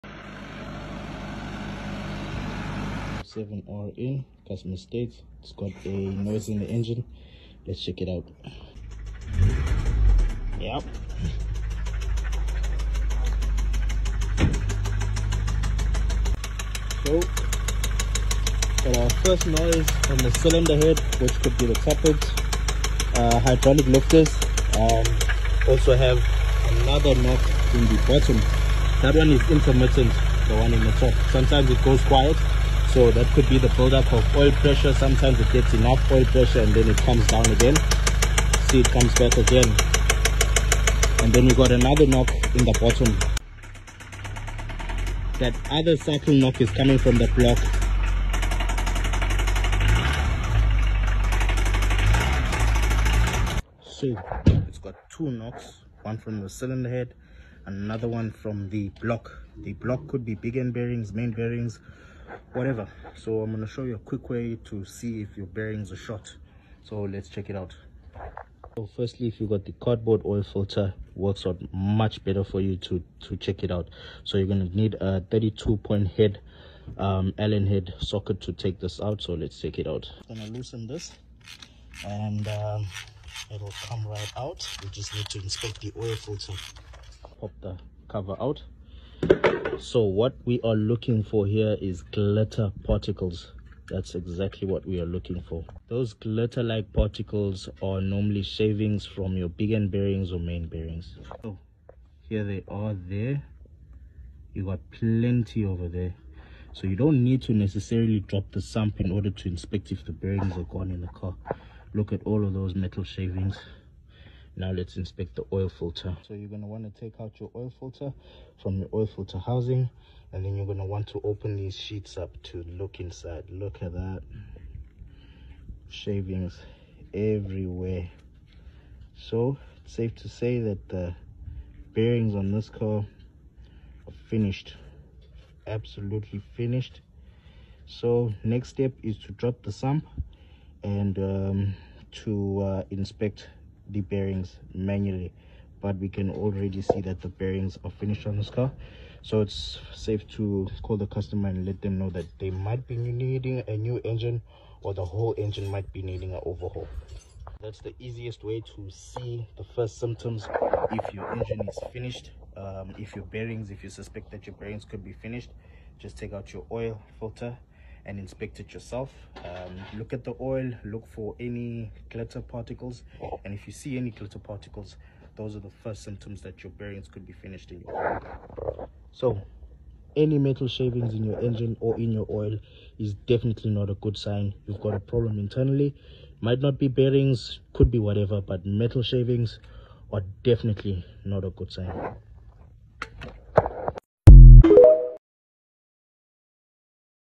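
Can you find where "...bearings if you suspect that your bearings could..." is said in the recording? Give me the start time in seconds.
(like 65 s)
163 s.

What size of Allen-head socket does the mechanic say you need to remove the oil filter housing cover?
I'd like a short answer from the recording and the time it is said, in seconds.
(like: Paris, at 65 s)
32 point, at 75 s.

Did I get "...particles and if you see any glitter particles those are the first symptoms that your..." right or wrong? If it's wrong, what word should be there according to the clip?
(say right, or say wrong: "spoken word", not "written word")
right.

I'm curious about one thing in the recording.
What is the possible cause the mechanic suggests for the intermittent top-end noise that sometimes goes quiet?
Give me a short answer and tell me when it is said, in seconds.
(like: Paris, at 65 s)
Buildup of oil pressure, at 33 s.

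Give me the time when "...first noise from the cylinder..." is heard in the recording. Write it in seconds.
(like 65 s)
19 s.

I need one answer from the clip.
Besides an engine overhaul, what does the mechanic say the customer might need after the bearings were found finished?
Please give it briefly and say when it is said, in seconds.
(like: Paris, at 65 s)
A new engine, at 153 s.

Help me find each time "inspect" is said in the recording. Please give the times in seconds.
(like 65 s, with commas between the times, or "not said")
85 s, 109 s, 114 s, 142 s, 168 s.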